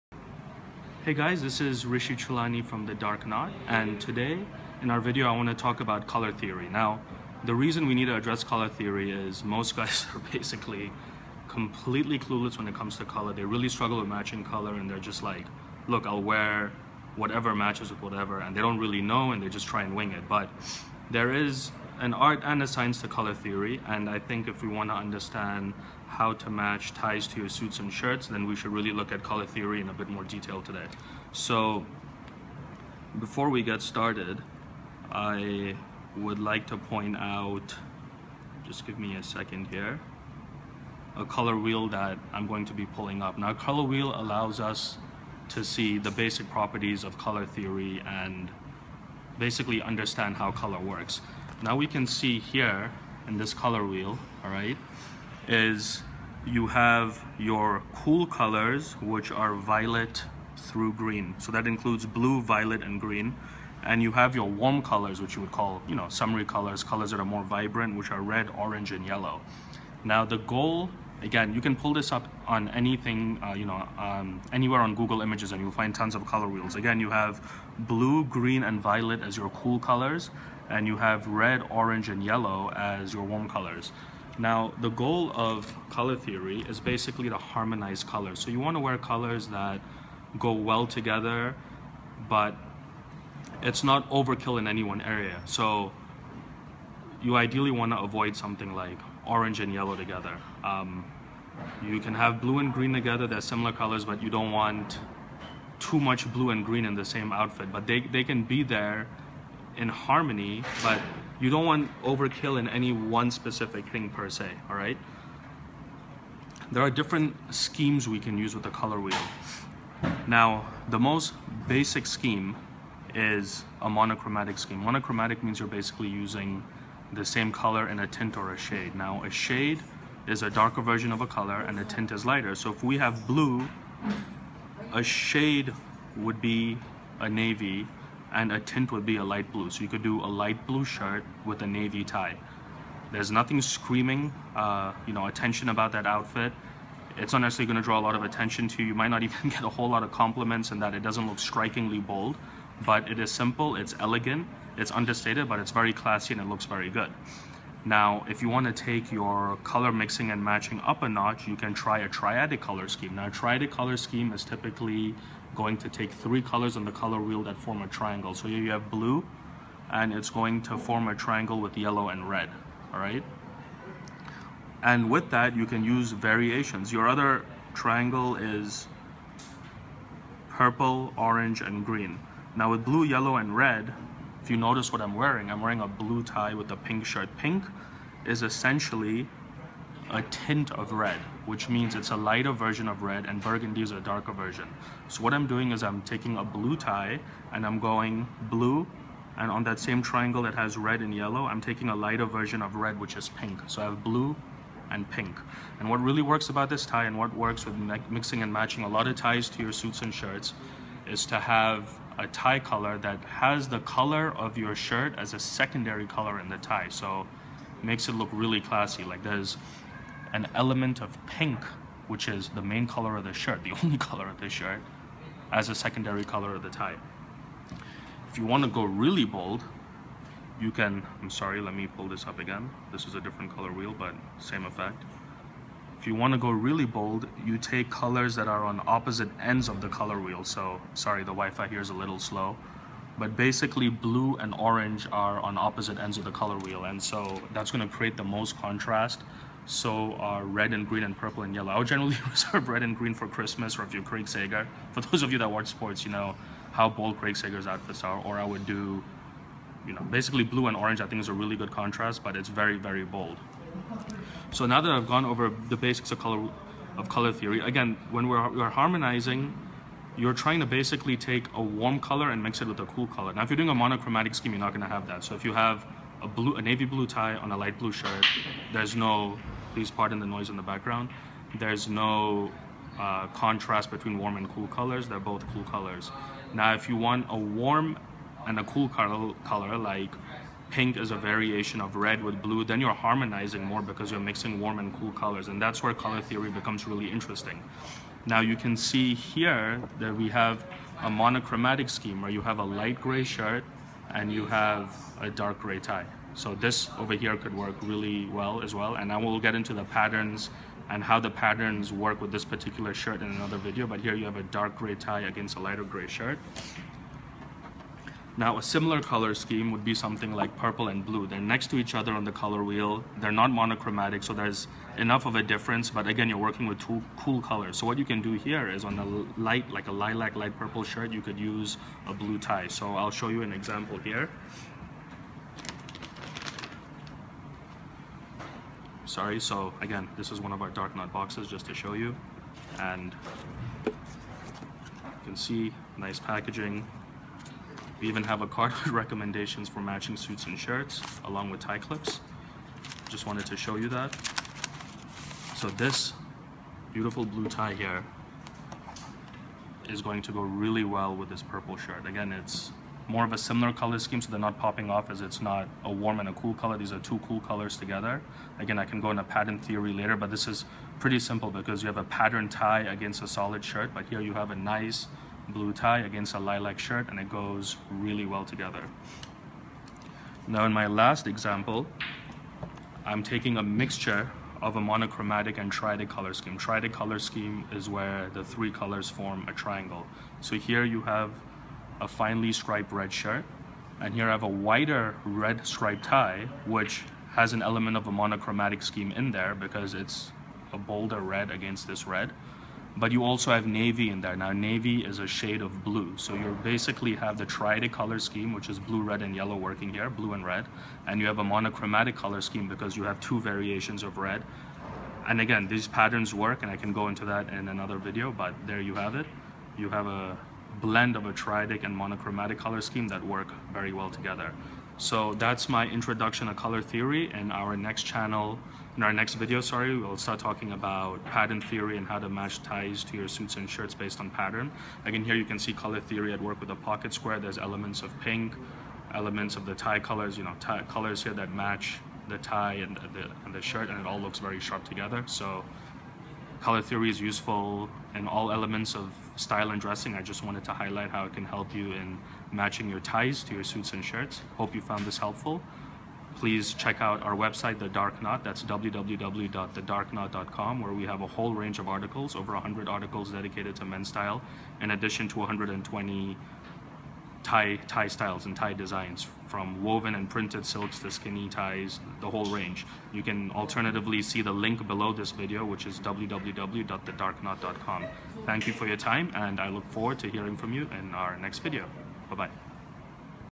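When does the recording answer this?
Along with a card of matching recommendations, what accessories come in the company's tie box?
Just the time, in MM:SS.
05:51.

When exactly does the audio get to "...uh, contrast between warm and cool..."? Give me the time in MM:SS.
04:42.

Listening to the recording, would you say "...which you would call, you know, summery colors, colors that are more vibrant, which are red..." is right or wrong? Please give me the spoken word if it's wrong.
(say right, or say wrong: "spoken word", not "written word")
right.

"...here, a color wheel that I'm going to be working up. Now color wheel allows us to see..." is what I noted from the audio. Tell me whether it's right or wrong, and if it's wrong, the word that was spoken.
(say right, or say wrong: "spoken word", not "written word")
wrong: "pulling", not "working".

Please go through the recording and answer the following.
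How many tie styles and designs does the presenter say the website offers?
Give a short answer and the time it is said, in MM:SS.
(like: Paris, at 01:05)
120, at 07:45.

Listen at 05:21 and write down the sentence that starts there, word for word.
They're next to each other on the color wheel.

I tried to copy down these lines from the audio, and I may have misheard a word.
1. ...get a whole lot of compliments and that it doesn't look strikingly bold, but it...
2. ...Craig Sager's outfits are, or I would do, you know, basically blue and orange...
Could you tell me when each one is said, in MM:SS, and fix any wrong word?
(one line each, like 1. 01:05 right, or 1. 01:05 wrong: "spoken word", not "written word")
1. 02:29 right
2. 04:17 right.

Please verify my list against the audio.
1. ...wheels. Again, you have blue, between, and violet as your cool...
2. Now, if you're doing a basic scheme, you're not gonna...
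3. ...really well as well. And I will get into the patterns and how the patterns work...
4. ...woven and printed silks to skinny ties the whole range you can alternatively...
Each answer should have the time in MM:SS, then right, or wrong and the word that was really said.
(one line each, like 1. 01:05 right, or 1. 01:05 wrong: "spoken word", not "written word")
1. 01:16 wrong: "green", not "between"
2. 04:33 wrong: "monochromatic", not "basic"
3. 05:07 right
4. 07:49 right.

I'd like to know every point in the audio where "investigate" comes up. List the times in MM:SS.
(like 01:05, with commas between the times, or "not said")
not said.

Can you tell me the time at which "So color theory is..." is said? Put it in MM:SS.
07:25.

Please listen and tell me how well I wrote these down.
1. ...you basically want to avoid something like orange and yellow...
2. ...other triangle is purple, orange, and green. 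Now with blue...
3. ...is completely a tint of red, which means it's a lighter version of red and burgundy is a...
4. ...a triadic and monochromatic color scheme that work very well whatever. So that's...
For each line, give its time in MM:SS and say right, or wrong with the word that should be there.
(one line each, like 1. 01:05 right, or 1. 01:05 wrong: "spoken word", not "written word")
1. 01:37 wrong: "ideally", not "basically"
2. 02:57 right
3. 03:08 wrong: "essentially", not "completely"
4. 07:01 wrong: "together", not "whatever".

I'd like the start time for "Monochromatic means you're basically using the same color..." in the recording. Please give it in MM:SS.
02:04.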